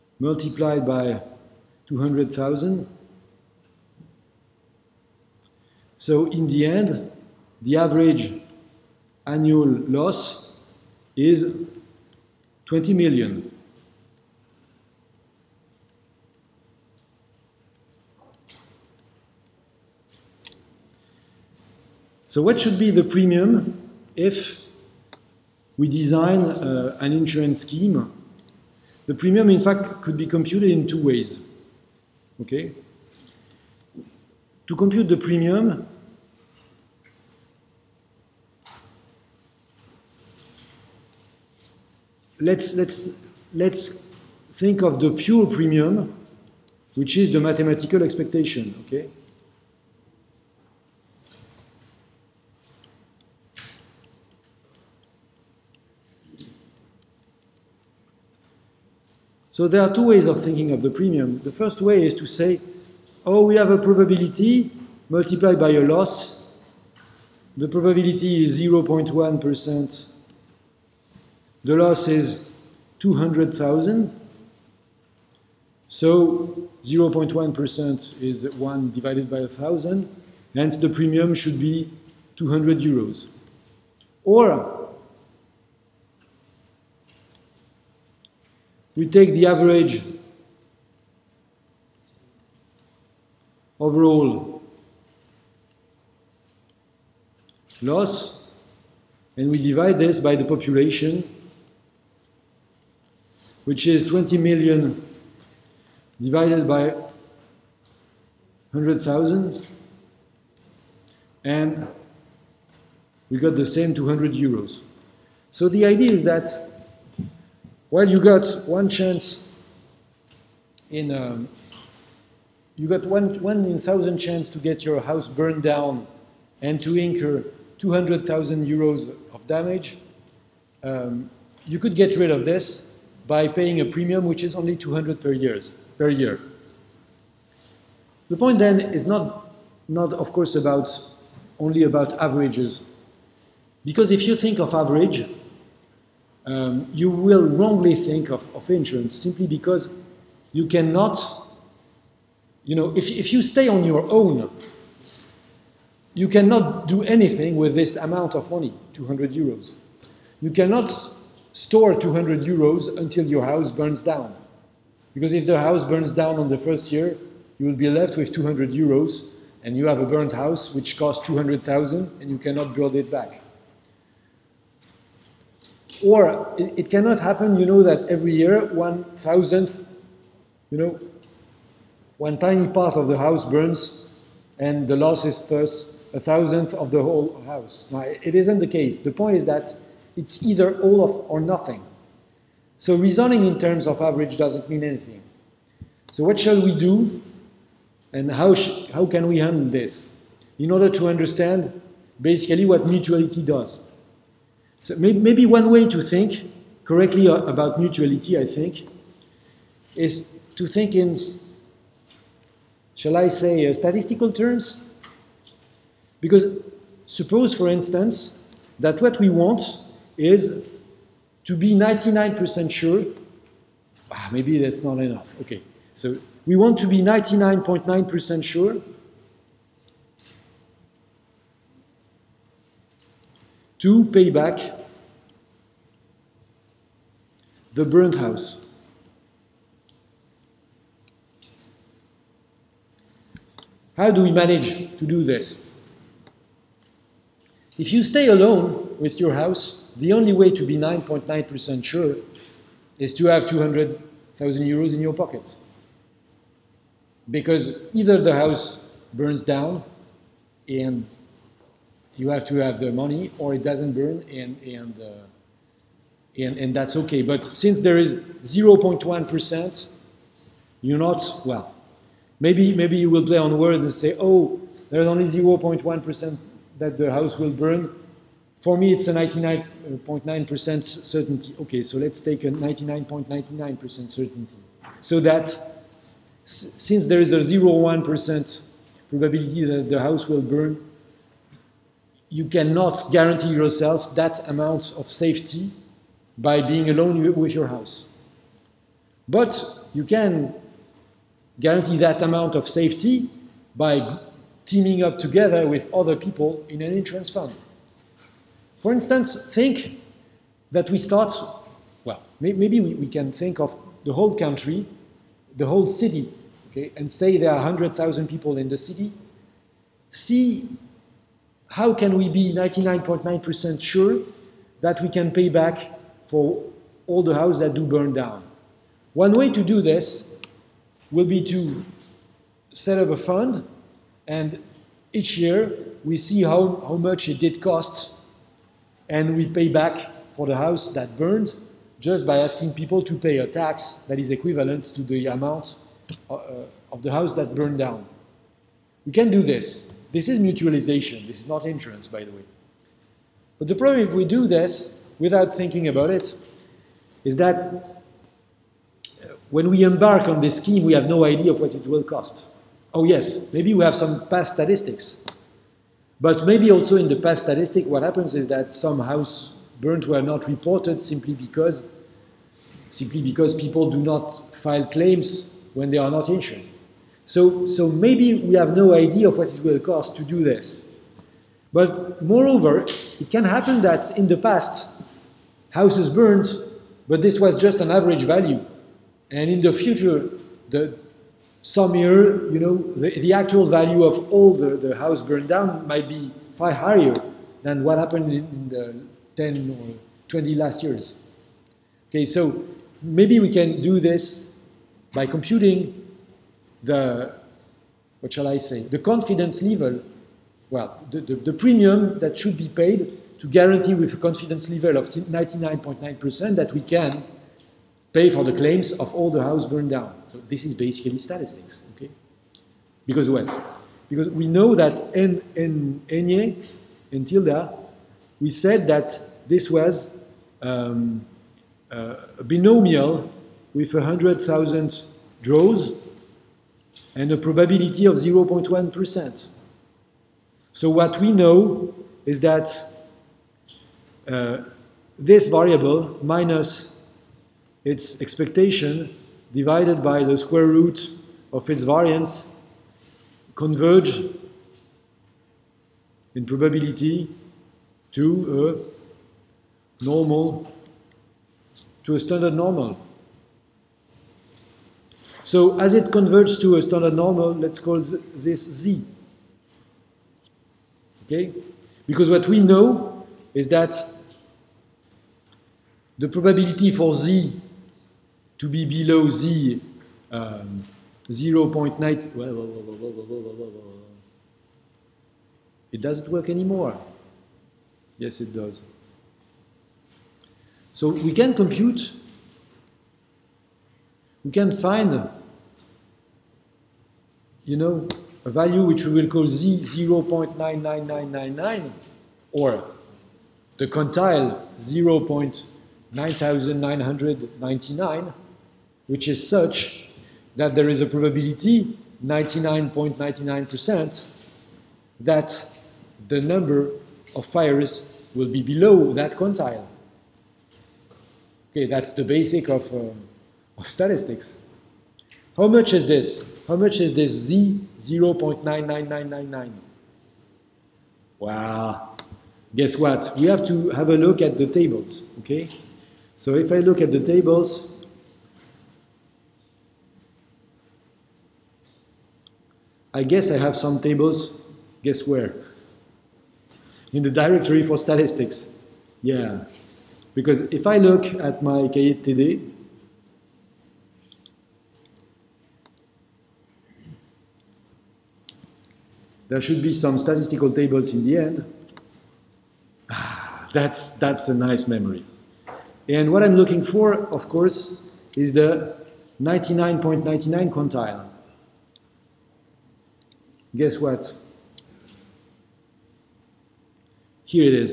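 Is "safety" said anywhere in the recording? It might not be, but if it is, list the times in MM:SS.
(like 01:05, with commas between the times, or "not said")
04:55, 05:02.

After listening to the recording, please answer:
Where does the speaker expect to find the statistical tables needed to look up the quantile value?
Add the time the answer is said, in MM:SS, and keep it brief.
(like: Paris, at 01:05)
directory for statistics, at 09:07.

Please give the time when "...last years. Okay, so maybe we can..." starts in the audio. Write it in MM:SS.
06:40.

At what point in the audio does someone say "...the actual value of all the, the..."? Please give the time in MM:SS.
06:33.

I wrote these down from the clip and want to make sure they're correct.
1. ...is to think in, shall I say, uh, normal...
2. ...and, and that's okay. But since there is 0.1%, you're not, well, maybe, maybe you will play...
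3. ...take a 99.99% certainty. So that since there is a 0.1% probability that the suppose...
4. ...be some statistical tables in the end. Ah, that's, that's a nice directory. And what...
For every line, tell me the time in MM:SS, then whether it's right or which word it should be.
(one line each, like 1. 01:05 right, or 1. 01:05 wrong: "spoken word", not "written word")
1. 03:29 wrong: "statistical", not "normal"
2. 04:26 right
3. 04:42 wrong: "house", not "suppose"
4. 09:19 wrong: "memory", not "directory".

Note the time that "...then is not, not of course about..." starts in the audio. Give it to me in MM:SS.
02:18.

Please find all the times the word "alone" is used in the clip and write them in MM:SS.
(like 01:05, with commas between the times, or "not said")
04:08, 04:56.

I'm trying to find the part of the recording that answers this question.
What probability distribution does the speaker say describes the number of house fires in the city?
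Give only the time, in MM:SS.
07:12.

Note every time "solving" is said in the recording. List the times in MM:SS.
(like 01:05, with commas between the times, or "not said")
not said.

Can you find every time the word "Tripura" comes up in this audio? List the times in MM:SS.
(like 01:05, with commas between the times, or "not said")
not said.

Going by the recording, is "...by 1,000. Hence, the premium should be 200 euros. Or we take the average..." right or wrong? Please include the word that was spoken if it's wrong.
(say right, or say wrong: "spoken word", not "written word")
right.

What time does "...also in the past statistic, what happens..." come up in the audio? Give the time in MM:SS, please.
06:06.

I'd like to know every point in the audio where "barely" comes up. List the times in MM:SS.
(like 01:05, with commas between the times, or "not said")
not said.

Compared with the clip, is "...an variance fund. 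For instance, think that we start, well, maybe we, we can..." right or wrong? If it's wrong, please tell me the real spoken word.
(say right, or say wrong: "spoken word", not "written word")
wrong: "insurance", not "variance".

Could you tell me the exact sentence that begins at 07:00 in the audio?
So this is basically statistics, okay?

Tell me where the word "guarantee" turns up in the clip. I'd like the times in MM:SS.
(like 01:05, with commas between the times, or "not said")
04:53, 05:01, 06:53.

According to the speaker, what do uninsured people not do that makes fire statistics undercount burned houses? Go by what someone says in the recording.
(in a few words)
file claims.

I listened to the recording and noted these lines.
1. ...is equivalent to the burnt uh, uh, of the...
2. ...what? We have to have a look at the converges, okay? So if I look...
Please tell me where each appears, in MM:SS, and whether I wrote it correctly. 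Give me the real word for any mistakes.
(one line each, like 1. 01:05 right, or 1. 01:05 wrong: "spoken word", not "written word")
1. 05:44 wrong: "amount", not "burnt"
2. 08:52 wrong: "tables", not "converges".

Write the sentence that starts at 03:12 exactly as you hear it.
So reasoning in terms of average doesn't mean anything.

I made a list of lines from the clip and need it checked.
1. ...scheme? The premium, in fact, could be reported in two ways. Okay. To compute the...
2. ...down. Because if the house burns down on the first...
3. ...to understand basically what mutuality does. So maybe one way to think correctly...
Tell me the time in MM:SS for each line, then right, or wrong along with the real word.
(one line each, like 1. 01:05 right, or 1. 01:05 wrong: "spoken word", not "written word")
1. 00:27 wrong: "computed", not "reported"
2. 02:44 right
3. 03:20 right.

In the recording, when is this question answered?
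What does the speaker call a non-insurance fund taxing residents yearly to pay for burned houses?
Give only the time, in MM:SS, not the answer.
05:50.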